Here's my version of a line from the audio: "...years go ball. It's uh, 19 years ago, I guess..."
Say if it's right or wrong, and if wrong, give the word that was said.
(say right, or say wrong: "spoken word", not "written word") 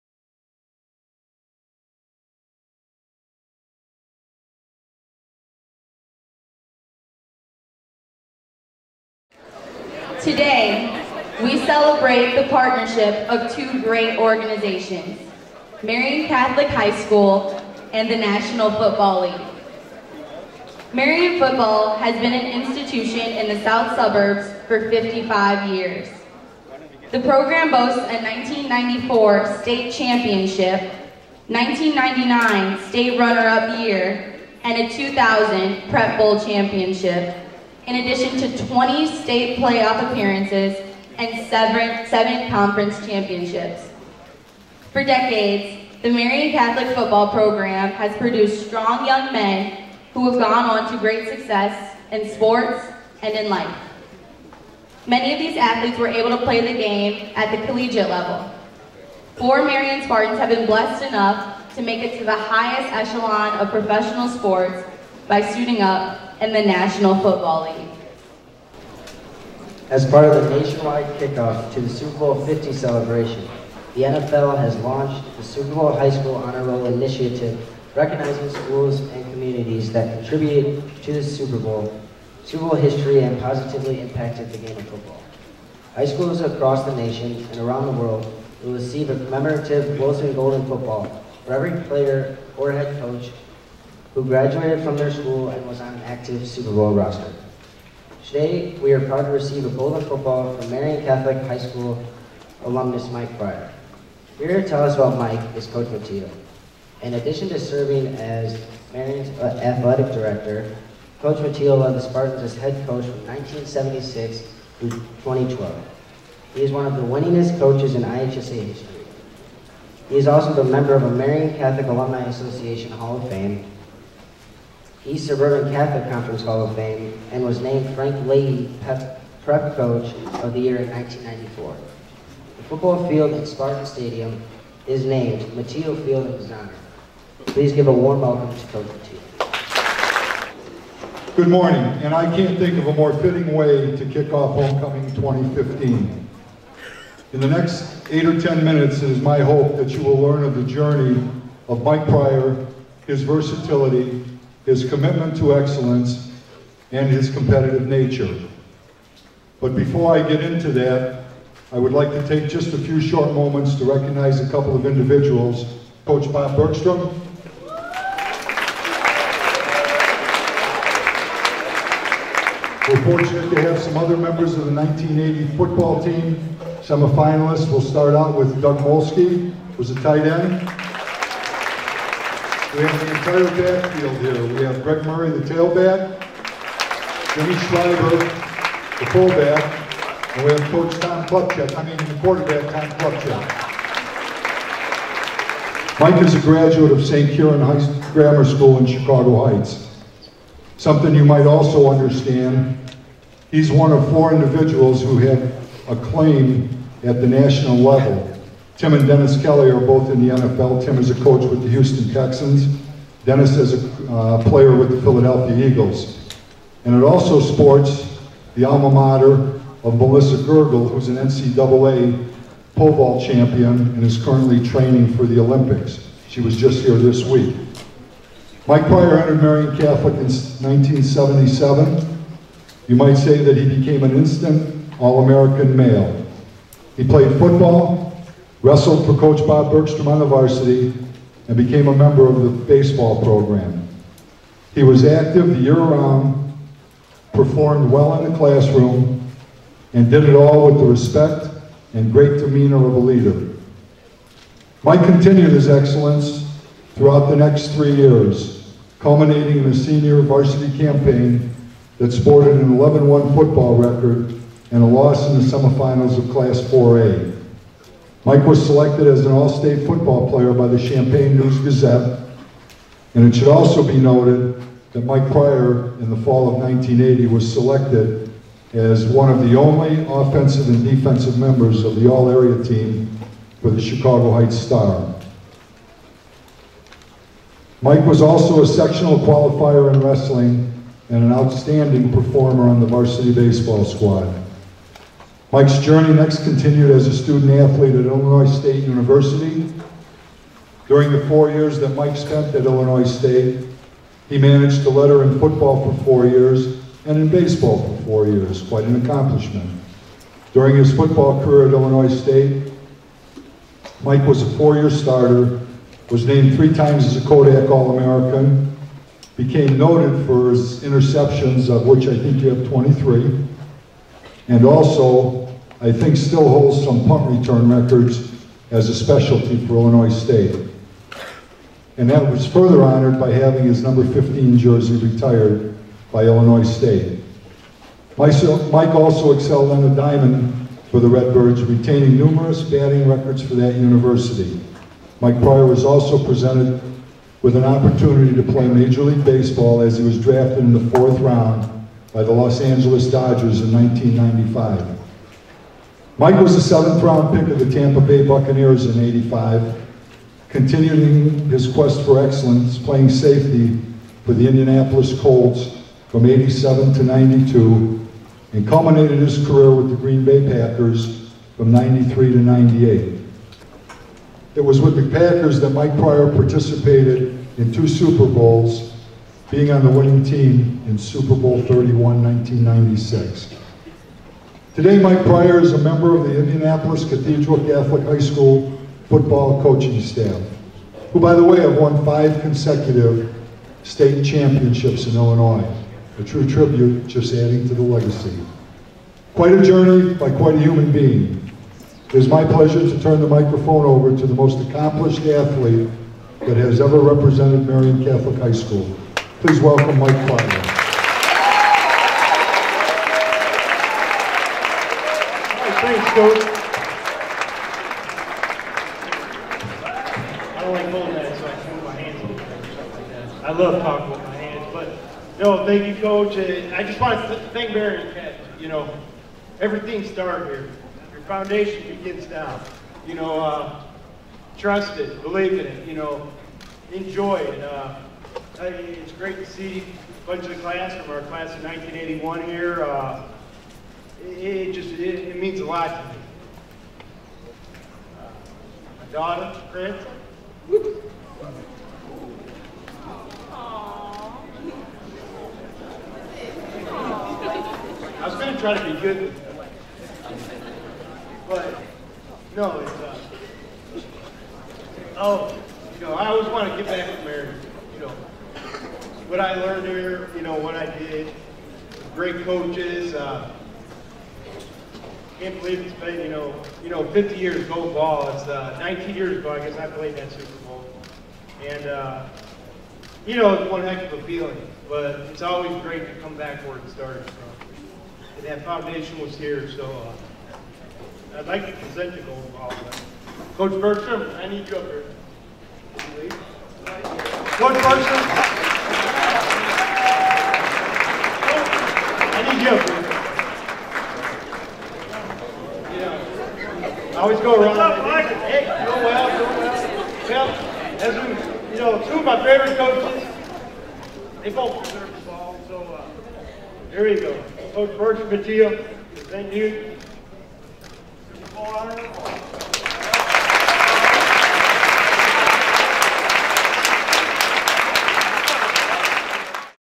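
right.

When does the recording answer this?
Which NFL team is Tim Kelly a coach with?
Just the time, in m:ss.
3:31.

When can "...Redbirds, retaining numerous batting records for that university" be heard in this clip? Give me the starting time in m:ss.
5:41.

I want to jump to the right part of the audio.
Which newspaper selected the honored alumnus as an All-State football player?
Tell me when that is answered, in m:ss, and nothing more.
4:30.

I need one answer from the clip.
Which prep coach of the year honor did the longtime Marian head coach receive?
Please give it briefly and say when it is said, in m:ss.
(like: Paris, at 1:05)
Frank Leahy Prep Coach of the Year, at 2:07.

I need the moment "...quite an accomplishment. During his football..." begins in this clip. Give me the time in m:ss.
5:08.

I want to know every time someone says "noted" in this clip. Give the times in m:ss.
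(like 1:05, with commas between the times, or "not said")
4:33, 5:19.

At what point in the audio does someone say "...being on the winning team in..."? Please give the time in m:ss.
6:19.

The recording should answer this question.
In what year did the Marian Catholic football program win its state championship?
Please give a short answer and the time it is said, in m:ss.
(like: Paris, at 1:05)
1994, at 0:28.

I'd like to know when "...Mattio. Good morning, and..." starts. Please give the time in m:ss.
2:18.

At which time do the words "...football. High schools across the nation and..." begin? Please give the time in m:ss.
1:24.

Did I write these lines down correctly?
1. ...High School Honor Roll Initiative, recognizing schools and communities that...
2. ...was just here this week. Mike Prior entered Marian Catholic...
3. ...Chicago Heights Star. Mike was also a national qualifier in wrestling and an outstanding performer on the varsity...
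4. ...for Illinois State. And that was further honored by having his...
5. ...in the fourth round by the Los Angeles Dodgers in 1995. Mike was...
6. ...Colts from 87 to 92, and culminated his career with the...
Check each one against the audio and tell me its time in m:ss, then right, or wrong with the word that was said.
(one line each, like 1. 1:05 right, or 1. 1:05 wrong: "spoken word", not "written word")
1. 1:15 right
2. 3:46 right
3. 4:43 wrong: "sectional", not "national"
4. 5:29 right
5. 5:50 right
6. 6:05 right.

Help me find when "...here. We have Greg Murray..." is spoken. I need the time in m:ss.
3:04.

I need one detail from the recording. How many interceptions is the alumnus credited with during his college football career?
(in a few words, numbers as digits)
23.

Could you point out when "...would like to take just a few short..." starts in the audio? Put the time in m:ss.
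2:41.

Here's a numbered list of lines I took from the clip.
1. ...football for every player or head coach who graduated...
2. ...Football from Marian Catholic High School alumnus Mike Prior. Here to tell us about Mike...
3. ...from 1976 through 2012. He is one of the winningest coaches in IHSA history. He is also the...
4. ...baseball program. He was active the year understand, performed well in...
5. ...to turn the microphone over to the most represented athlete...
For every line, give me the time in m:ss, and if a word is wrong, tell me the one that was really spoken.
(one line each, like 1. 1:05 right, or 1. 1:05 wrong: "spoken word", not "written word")
1. 1:30 right
2. 1:40 right
3. 1:53 right
4. 4:02 wrong: "round", not "understand"
5. 6:42 wrong: "accomplished", not "represented".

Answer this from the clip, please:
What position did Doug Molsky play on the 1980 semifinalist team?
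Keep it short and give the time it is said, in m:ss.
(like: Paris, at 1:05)
Tight end, at 3:00.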